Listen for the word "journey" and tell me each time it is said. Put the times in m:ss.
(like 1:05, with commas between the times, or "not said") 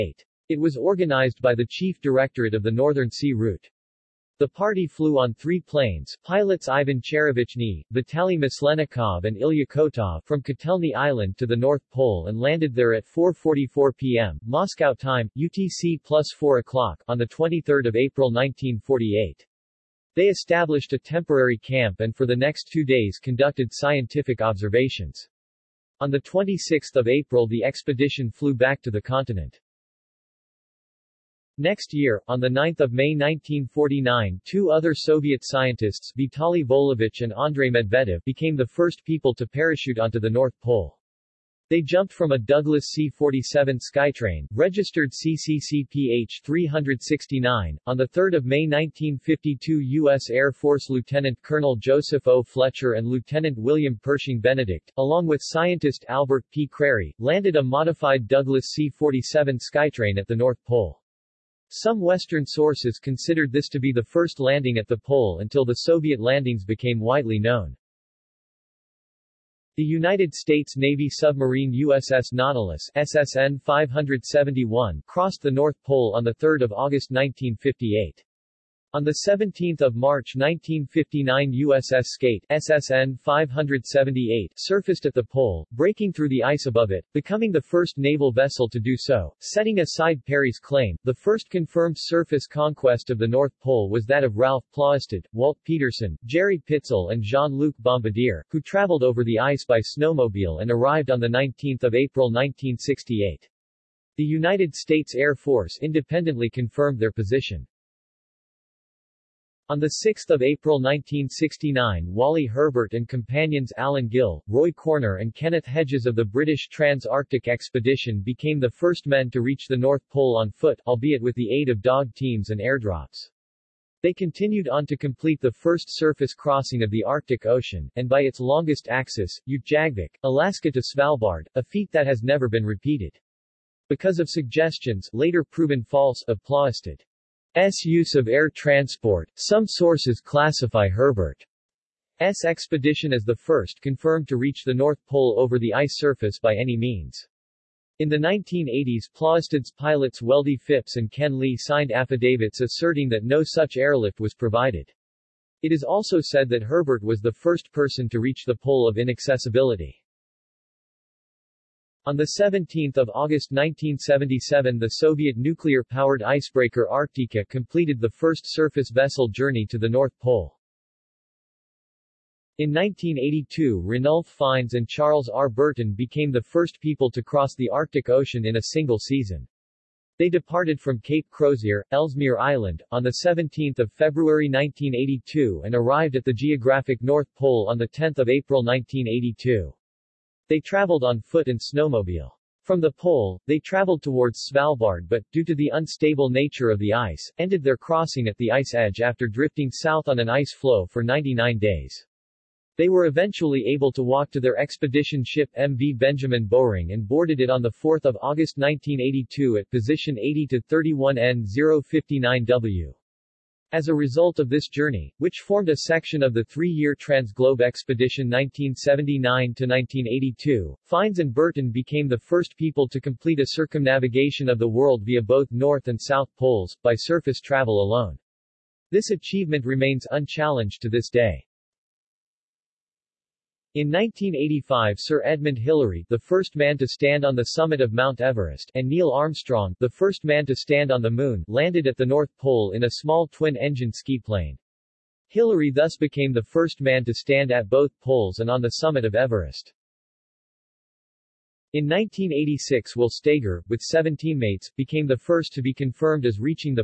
2:49, 3:34.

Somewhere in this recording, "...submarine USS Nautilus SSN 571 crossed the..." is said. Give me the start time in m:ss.
1:11.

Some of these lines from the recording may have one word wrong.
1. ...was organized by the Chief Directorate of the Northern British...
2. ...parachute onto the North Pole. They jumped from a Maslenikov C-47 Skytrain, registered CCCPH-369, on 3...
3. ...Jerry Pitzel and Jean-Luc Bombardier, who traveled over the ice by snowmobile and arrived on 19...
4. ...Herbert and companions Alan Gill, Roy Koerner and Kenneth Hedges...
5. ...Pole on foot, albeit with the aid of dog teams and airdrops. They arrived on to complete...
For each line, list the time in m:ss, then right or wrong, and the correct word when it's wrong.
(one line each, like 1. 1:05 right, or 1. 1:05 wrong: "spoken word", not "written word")
1. 0:00 wrong: "Sea", not "British"
2. 0:39 wrong: "Douglas", not "Maslenikov"
3. 1:36 right
4. 1:52 right
5. 2:00 wrong: "continued", not "arrived".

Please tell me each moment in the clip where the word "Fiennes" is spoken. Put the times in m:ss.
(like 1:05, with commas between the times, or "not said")
2:54, 3:40.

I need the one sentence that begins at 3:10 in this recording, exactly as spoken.
They traveled on foot and snowmobile.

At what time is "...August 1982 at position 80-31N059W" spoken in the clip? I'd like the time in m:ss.
3:28.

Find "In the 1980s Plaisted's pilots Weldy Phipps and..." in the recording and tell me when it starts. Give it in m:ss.
2:27.